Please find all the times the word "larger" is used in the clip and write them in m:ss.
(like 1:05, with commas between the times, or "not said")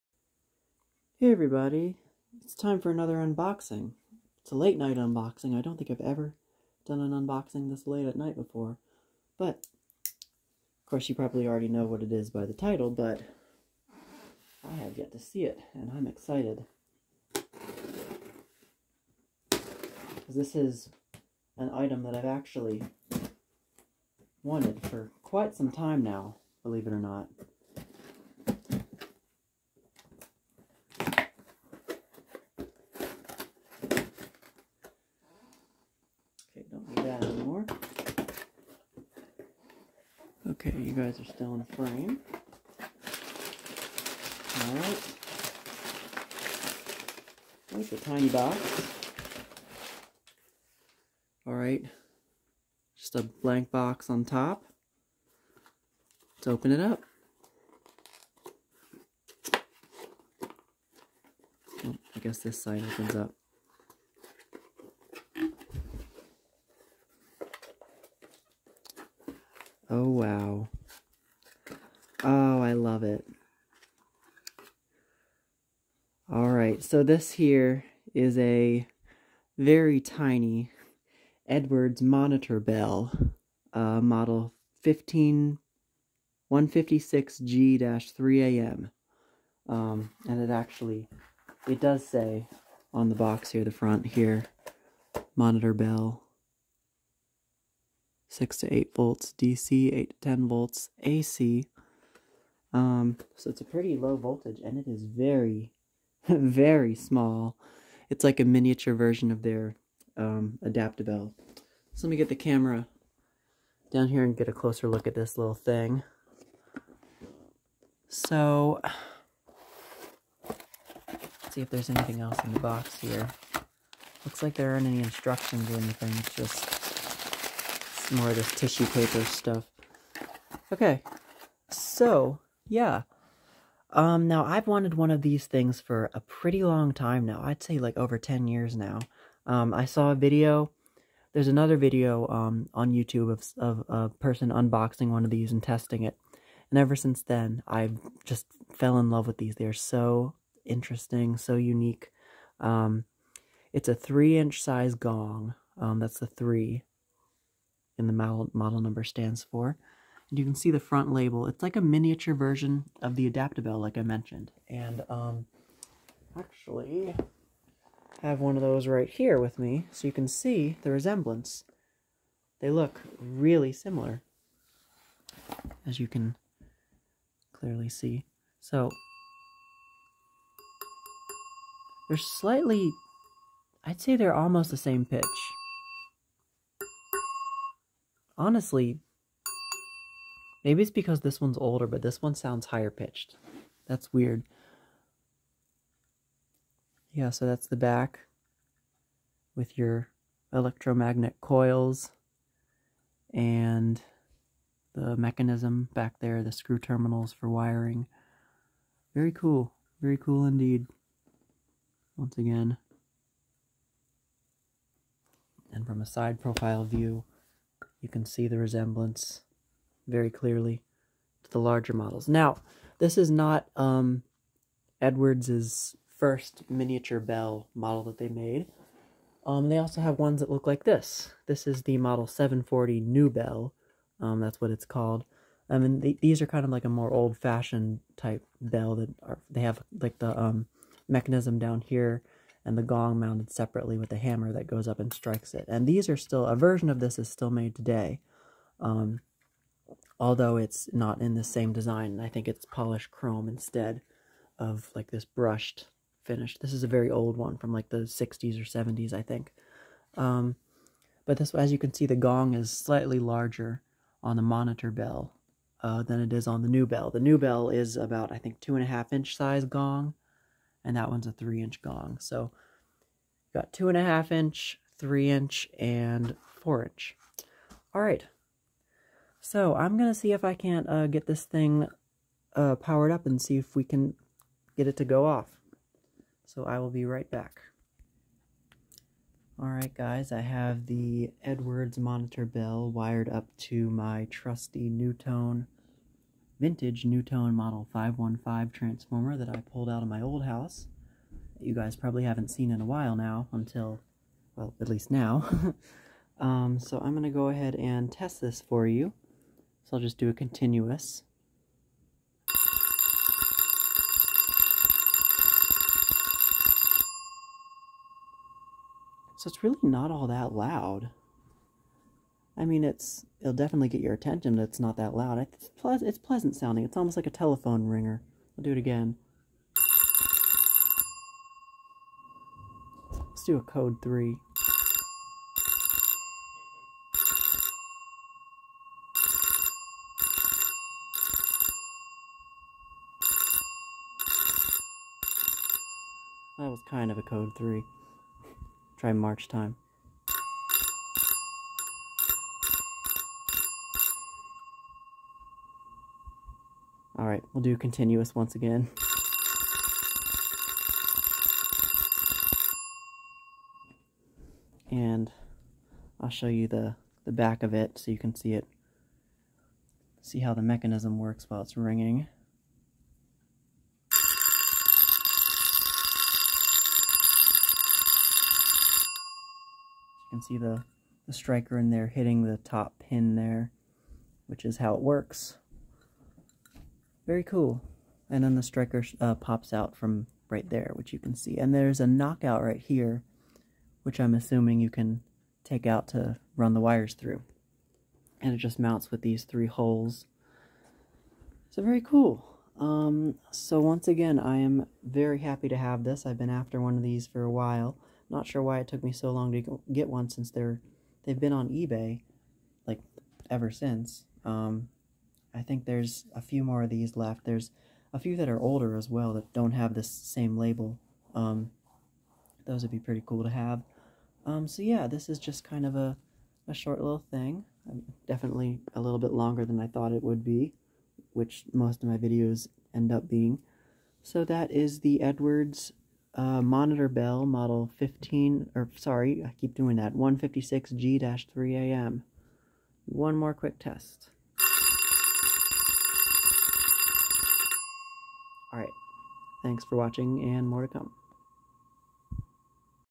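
3:41, 4:23.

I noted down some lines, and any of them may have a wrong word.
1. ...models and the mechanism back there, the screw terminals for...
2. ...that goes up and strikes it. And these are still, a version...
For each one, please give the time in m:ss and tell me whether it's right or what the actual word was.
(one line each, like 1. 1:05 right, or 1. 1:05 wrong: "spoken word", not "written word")
1. 3:21 wrong: "coils", not "models"
2. 4:04 right.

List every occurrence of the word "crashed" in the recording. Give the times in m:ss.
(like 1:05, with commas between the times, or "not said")
not said.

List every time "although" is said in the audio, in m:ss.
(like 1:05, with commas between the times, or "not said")
4:10.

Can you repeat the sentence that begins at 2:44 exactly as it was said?
And um, actually have one of those right here with me, so you can see the resemblance.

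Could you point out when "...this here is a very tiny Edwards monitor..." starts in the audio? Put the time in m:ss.
1:17.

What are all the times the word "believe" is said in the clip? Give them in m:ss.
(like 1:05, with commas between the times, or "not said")
0:26.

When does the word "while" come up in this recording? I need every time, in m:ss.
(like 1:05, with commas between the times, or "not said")
5:02, 6:11, 6:47.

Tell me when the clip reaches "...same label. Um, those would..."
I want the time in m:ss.
7:00.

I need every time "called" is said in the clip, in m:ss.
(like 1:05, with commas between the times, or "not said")
3:54.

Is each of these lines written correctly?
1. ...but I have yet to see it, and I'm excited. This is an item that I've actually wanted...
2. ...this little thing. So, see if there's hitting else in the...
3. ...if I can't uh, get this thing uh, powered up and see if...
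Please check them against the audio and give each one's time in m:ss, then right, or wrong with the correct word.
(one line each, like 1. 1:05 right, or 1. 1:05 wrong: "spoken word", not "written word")
1. 0:12 right
2. 1:55 wrong: "anything", not "hitting"
3. 4:40 right.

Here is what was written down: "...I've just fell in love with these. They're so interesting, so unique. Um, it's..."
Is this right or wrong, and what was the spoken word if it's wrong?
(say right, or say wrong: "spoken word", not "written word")
right.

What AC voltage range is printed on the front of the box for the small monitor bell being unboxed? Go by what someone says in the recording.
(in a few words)
8 to 10 volts.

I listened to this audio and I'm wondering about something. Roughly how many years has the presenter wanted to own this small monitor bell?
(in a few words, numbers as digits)
over 10 years.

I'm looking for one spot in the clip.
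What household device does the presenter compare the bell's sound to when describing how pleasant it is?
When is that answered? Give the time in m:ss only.
5:27.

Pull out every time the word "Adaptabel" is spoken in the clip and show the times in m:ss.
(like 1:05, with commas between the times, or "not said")
1:50, 2:43.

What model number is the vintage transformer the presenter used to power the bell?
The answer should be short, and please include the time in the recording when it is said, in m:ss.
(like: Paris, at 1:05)
515, at 4:57.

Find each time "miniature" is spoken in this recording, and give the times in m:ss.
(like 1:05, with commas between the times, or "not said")
1:48, 2:41, 3:46.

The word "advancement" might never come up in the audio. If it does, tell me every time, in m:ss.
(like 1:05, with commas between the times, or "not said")
not said.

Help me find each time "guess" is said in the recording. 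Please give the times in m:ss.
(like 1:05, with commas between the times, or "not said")
1:02.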